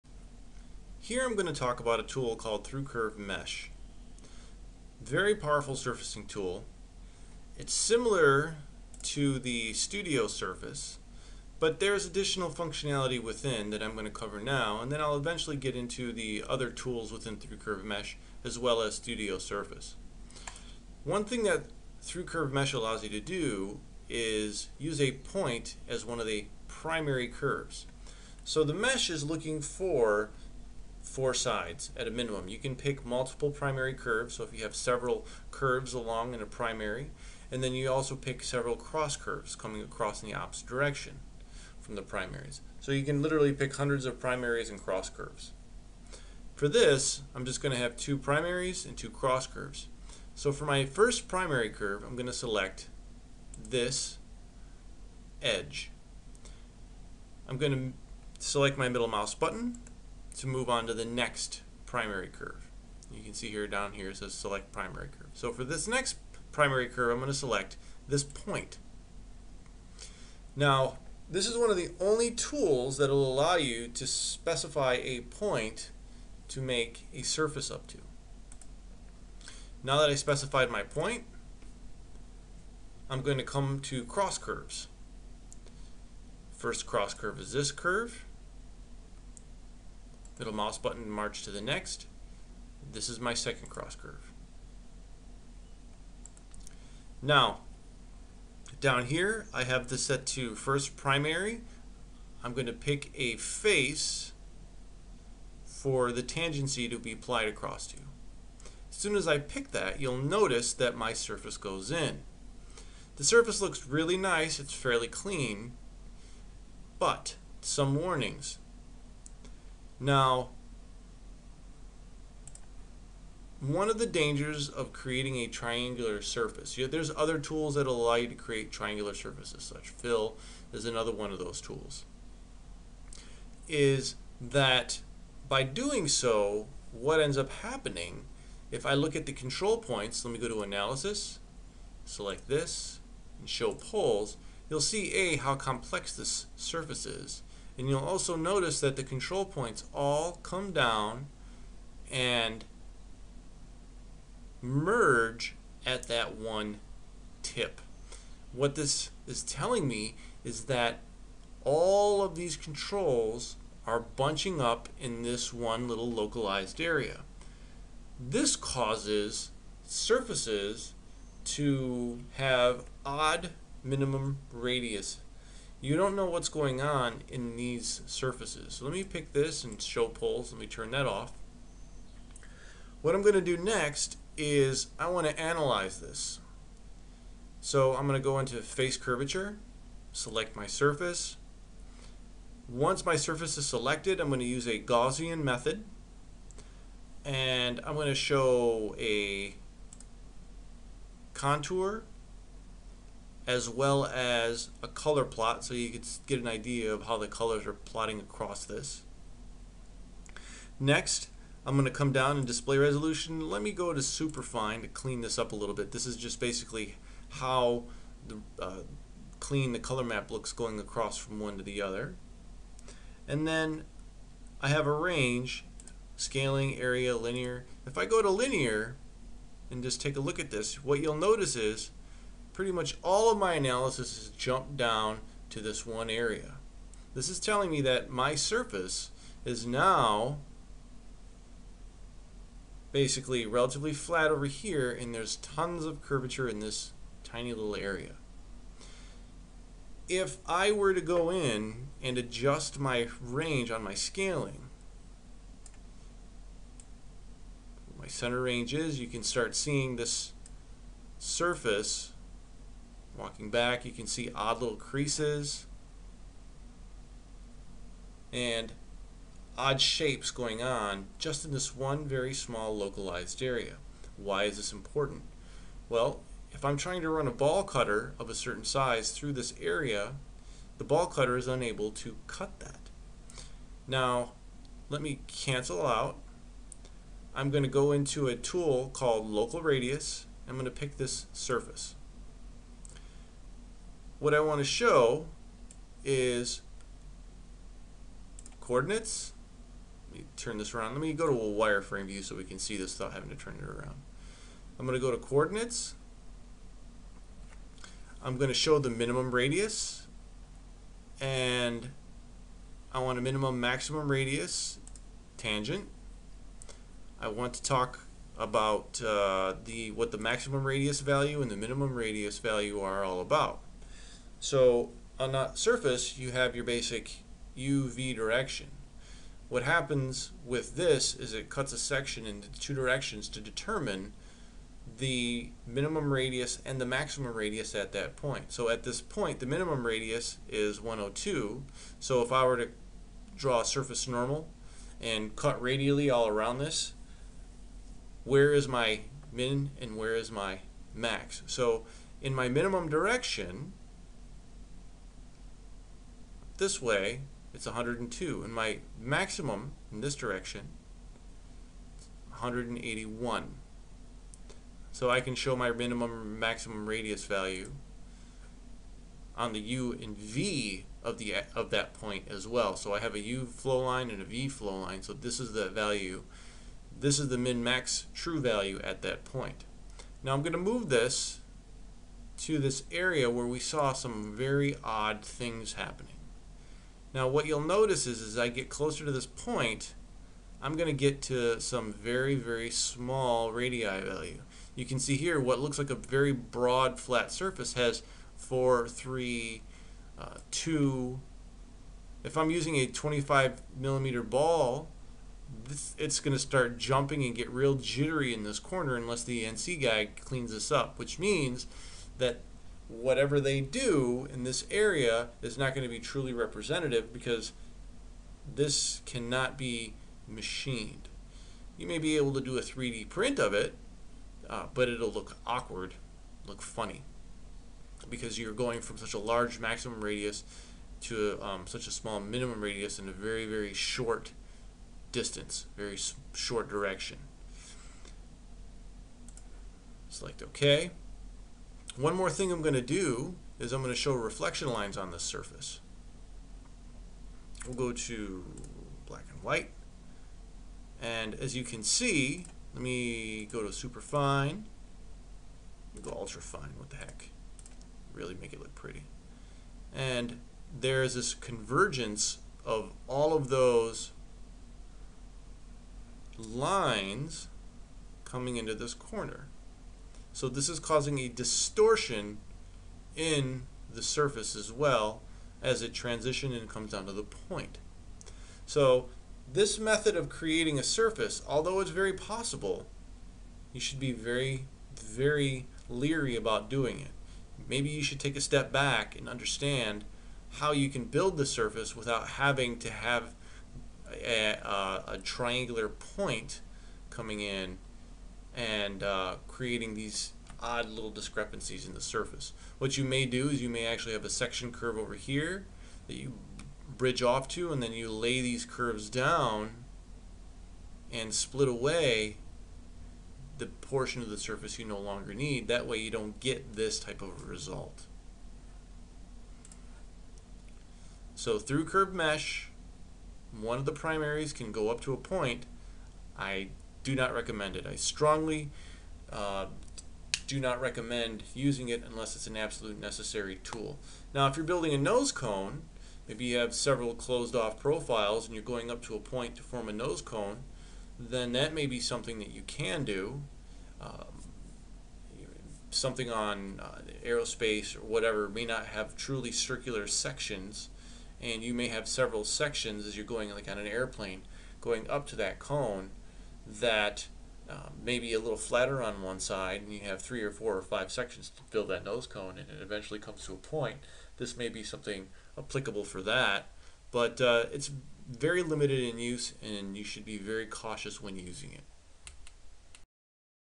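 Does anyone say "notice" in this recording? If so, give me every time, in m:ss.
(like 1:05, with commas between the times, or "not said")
1:50, 2:28, 3:51, 6:27.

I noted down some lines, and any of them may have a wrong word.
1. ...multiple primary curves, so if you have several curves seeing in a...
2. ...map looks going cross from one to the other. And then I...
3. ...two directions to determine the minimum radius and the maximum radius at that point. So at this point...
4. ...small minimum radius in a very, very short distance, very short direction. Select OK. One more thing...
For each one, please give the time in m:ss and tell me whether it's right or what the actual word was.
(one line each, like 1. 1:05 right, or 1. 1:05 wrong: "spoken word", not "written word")
1. 0:33 wrong: "along", not "seeing"
2. 3:40 wrong: "across", not "cross"
3. 5:32 right
4. 7:11 right.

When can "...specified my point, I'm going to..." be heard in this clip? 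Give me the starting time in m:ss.
1:20.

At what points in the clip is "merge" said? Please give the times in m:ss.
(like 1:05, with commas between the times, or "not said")
2:34.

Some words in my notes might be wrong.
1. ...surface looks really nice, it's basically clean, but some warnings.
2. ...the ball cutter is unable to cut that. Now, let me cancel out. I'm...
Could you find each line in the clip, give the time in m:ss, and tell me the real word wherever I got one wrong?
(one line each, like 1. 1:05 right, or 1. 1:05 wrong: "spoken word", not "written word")
1. 1:53 wrong: "fairly", not "basically"
2. 4:40 right.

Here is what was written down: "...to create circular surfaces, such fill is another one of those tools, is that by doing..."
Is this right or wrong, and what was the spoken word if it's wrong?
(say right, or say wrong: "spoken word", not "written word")
wrong: "triangular", not "circular".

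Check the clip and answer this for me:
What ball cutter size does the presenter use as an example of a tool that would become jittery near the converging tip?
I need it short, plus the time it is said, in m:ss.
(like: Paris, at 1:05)
25 millimeters, at 6:42.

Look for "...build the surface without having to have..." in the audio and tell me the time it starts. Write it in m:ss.
8:11.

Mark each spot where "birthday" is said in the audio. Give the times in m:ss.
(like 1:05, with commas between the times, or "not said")
not said.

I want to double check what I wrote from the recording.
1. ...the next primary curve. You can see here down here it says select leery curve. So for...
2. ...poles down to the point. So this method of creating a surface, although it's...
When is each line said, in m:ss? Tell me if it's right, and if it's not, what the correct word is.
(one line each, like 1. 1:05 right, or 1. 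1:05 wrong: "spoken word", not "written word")
1. 1:00 wrong: "primary", not "leery"
2. 7:56 wrong: "comes", not "poles".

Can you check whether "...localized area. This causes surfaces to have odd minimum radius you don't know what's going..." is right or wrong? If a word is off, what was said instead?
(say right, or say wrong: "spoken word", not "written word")
right.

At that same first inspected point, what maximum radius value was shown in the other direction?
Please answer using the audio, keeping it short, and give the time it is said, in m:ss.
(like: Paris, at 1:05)
181, at 6:02.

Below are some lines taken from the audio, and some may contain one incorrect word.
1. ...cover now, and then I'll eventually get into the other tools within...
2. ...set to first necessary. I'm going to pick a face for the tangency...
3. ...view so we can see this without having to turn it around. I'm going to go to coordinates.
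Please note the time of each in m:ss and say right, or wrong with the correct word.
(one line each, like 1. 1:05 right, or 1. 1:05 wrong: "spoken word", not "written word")
1. 0:14 right
2. 1:40 wrong: "primary", not "necessary"
3. 5:02 right.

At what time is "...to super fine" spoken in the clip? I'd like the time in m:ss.
7:33.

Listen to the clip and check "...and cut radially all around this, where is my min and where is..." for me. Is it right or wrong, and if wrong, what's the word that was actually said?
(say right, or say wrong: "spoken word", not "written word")
right.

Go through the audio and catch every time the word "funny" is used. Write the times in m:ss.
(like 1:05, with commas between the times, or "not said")
7:06.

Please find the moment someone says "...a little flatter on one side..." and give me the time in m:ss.
9:18.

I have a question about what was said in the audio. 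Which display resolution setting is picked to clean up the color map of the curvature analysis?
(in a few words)
Superfine.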